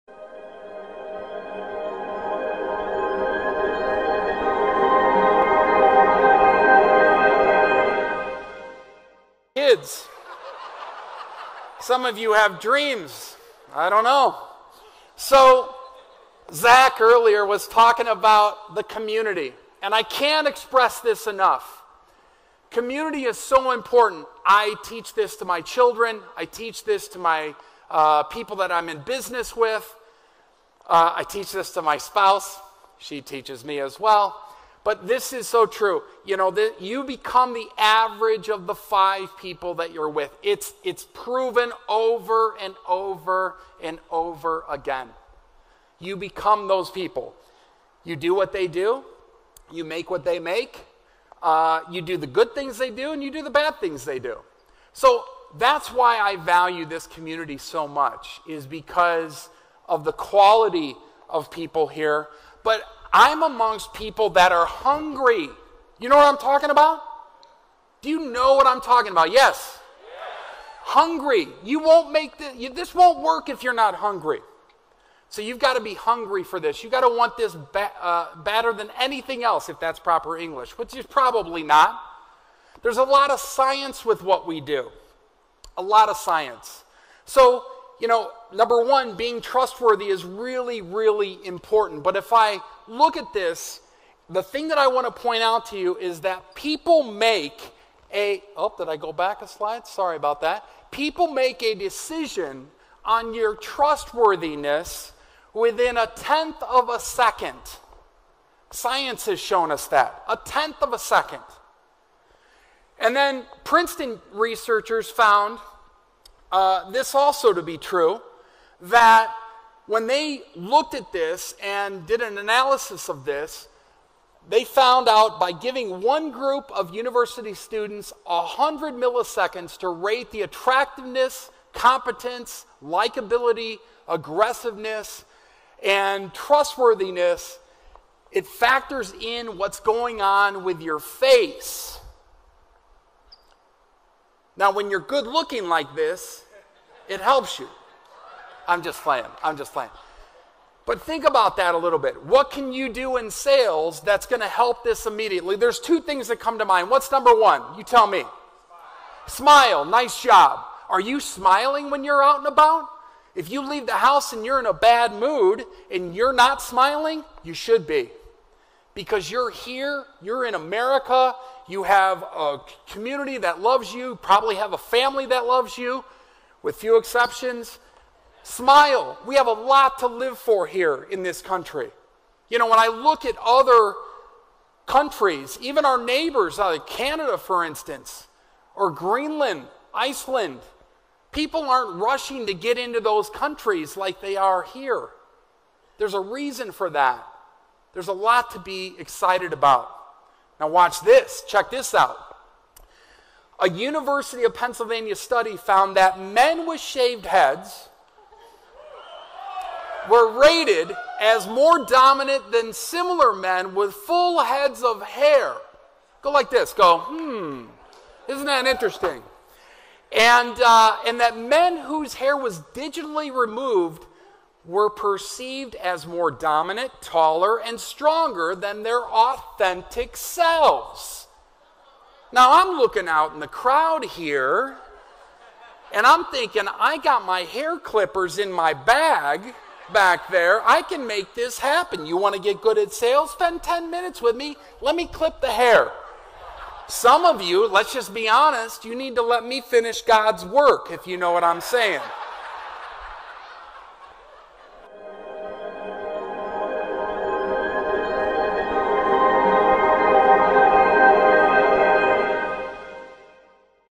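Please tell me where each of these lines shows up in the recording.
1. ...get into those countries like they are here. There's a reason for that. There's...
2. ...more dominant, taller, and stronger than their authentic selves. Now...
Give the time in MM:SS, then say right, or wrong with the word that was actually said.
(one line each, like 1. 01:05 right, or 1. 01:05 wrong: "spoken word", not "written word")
1. 03:12 right
2. 03:46 right.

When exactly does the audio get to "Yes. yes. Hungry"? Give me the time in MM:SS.
01:09.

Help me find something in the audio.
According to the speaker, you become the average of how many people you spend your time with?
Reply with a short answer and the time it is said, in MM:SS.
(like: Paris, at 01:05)
5, at 00:38.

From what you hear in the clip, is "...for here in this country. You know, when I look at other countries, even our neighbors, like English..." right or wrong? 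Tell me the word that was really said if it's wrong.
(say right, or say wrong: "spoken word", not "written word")
wrong: "Canada", not "English".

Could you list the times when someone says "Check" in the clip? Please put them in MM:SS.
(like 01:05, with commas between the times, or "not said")
03:21.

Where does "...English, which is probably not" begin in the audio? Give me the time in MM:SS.
01:20.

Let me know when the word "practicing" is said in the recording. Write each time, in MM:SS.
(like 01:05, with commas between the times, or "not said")
not said.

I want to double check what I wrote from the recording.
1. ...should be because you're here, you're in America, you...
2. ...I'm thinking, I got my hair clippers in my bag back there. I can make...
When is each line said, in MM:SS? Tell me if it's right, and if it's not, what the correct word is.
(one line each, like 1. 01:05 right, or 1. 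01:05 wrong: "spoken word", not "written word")
1. 02:47 right
2. 03:56 right.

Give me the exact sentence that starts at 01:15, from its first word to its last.
So you've got to be hungry for this.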